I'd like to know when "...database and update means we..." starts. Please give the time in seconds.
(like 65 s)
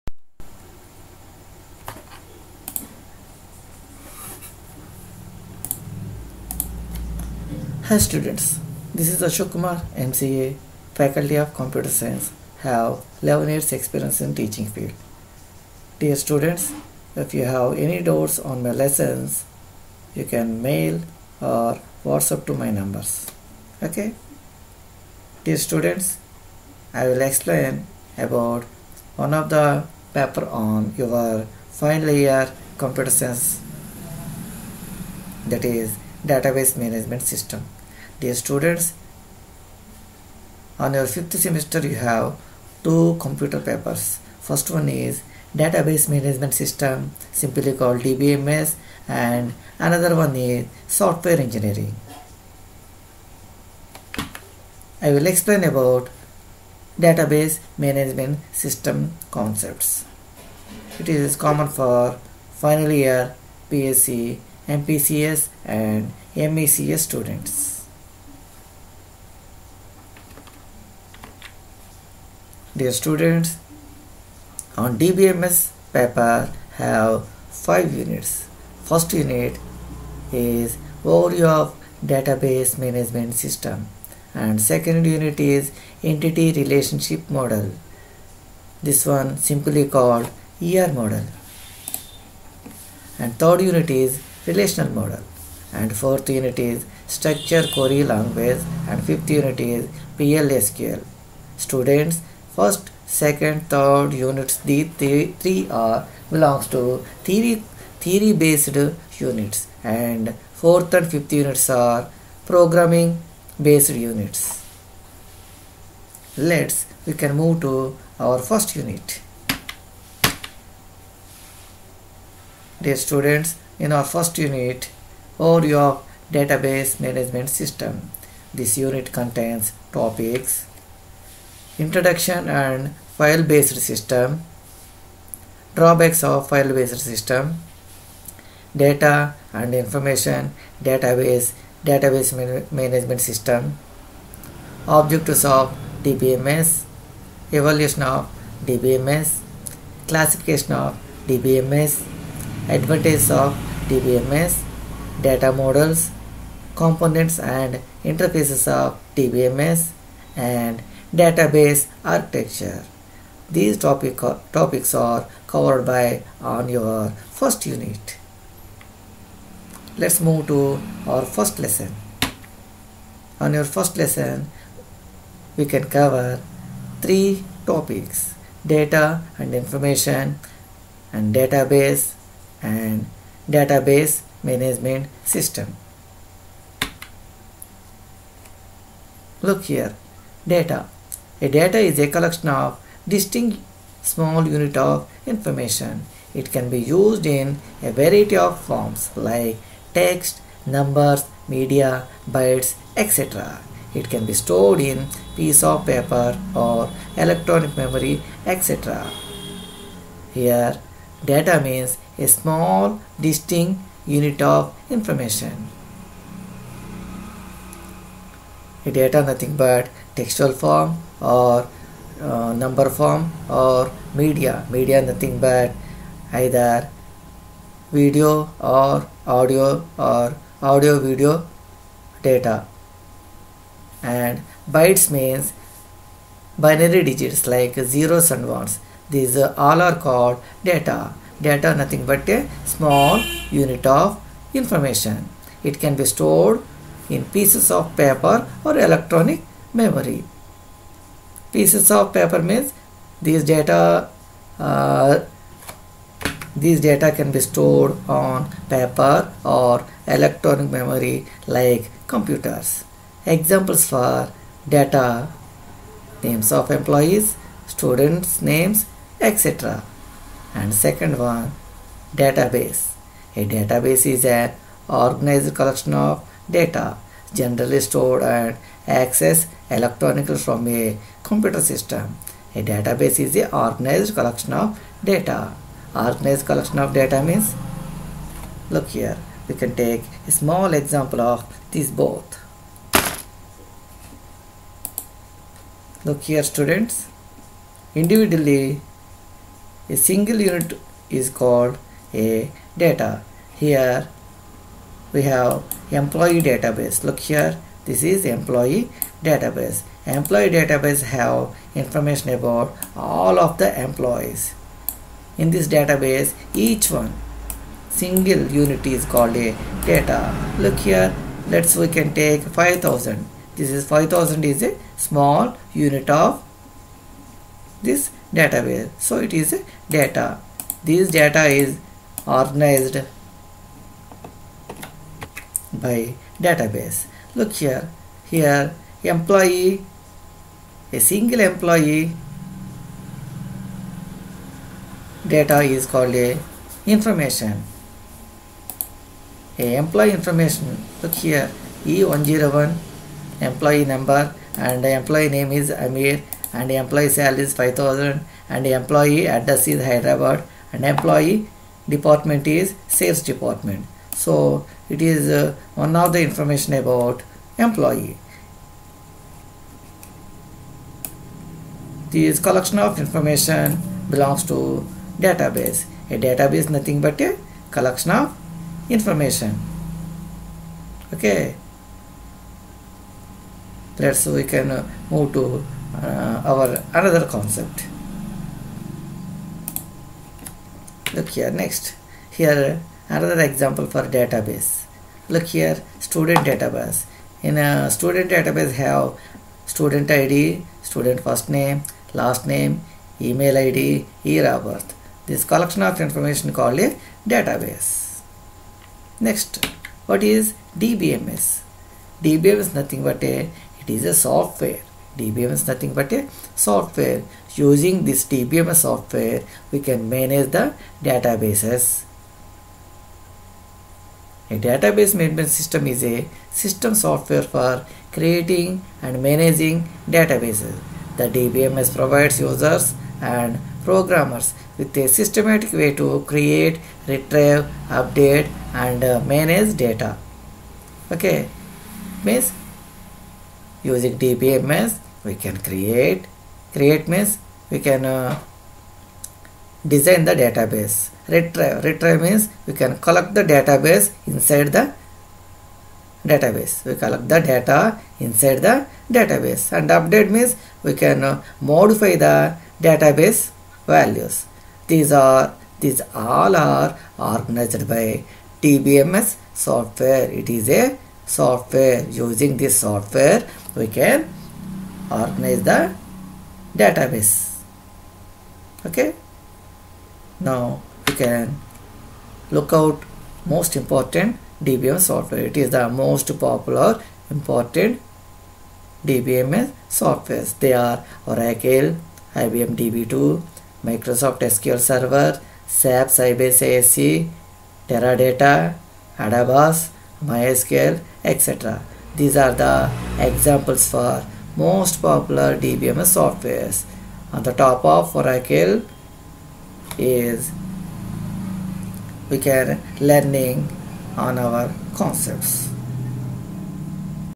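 459 s.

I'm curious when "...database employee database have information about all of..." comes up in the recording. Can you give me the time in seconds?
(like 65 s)
309 s.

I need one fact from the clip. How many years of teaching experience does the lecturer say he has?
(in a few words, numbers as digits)
11.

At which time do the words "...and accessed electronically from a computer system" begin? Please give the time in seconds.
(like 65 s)
278 s.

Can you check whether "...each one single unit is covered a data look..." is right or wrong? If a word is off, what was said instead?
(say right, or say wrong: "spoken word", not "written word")
wrong: "called", not "covered".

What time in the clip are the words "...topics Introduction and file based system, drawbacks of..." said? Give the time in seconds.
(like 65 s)
129 s.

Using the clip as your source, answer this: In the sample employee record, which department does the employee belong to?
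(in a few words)
Sales.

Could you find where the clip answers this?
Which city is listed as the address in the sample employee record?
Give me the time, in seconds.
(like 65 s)
359 s.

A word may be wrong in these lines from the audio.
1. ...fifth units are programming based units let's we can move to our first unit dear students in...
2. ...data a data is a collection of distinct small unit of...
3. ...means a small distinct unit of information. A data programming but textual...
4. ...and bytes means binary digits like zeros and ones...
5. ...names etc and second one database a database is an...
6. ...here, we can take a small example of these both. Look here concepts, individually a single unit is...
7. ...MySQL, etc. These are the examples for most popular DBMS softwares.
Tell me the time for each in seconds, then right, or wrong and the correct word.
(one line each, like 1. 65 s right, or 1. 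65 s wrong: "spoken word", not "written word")
1. 111 s right
2. 190 s right
3. 211 s wrong: "nothing", not "programming"
4. 234 s right
5. 268 s right
6. 288 s wrong: "students", not "concepts"
7. 500 s right.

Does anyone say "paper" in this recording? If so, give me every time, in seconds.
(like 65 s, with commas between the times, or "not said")
30 s, 43 s, 75 s, 205 s, 247 s, 252 s, 258 s.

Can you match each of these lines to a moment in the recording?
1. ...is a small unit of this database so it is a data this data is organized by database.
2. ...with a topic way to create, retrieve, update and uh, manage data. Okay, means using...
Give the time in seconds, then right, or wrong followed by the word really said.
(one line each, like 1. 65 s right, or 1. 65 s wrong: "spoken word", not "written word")
1. 324 s right
2. 434 s wrong: "systematic", not "topic".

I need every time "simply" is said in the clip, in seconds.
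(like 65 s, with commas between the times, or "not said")
47 s, 89 s.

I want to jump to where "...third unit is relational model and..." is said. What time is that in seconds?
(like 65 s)
93 s.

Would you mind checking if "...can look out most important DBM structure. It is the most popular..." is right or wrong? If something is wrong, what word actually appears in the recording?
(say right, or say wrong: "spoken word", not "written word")
wrong: "software", not "structure".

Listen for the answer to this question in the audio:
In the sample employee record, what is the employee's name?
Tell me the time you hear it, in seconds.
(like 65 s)
355 s.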